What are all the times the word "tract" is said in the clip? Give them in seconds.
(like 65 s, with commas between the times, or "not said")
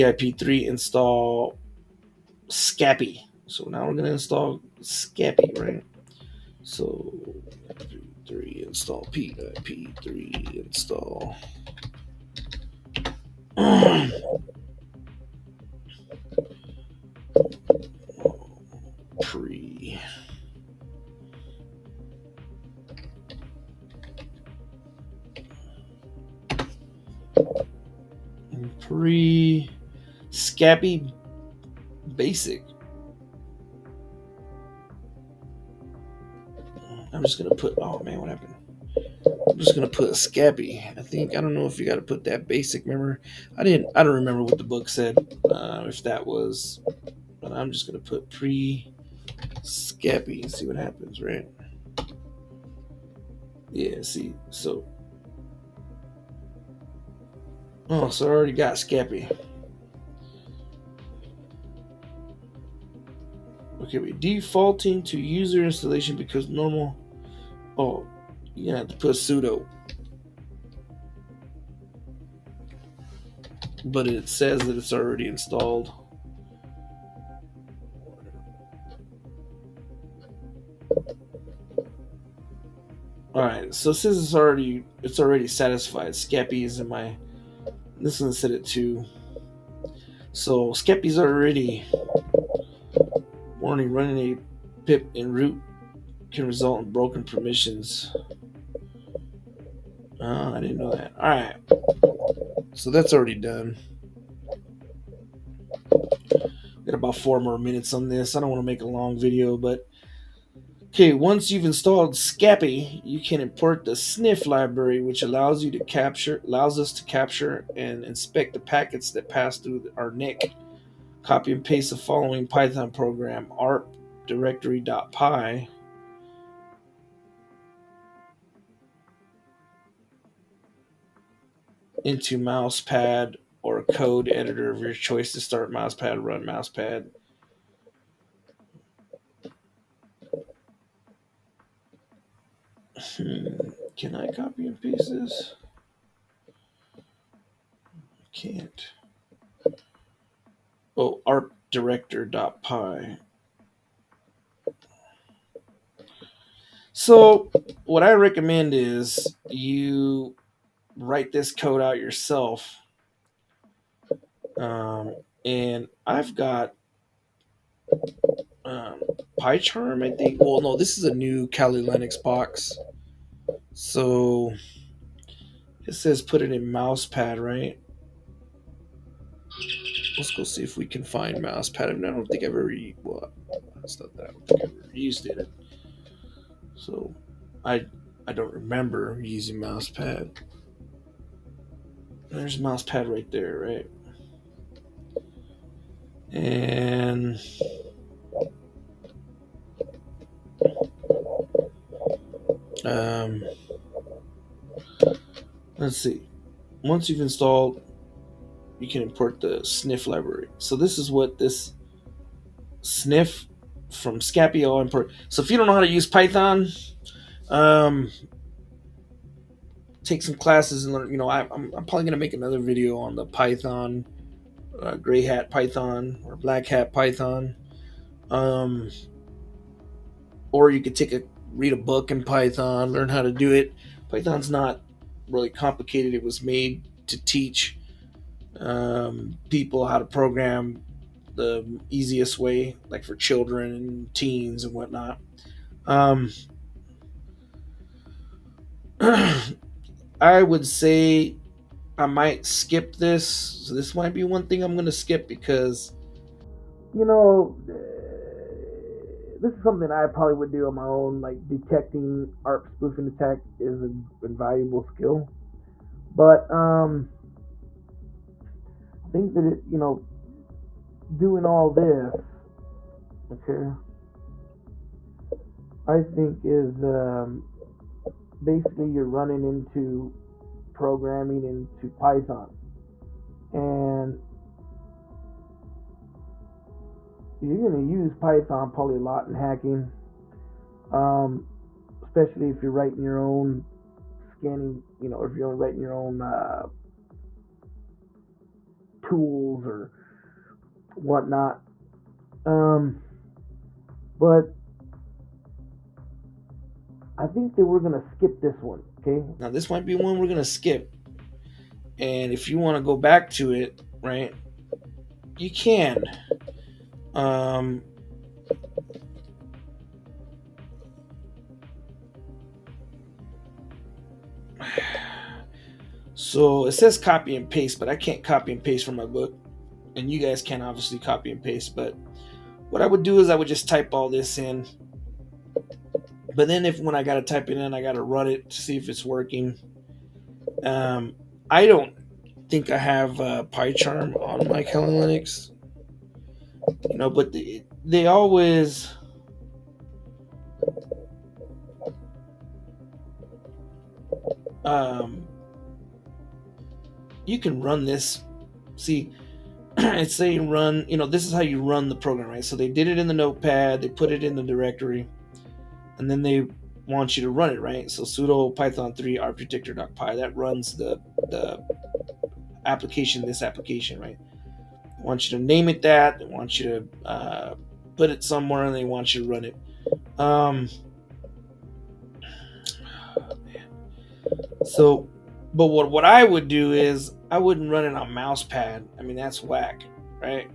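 not said.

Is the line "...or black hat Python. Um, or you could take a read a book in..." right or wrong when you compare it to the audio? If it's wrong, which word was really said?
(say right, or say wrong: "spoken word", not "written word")
right.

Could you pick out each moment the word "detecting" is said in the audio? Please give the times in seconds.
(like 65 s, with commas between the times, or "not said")
261 s.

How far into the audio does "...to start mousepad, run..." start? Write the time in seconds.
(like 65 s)
135 s.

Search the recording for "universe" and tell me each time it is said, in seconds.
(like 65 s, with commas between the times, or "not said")
not said.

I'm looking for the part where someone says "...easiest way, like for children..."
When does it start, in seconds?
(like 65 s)
241 s.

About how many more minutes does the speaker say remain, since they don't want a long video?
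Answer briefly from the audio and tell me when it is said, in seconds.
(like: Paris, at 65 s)
4, at 107 s.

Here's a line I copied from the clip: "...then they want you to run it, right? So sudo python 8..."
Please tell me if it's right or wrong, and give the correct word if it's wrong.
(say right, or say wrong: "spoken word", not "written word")
wrong: "3", not "8".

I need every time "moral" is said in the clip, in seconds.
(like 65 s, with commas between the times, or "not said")
not said.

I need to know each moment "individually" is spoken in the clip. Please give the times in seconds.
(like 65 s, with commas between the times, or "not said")
not said.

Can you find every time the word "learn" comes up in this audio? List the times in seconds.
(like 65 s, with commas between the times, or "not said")
220 s, 232 s.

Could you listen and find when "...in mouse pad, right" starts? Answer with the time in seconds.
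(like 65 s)
176 s.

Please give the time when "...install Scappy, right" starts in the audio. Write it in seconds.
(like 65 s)
4 s.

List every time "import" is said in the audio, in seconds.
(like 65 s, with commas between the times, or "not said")
113 s, 209 s, 214 s.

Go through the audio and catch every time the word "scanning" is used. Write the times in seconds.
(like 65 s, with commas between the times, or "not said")
294 s.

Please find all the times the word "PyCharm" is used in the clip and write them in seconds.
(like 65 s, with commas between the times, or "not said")
169 s, 343 s.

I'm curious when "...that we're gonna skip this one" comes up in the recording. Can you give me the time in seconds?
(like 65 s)
307 s.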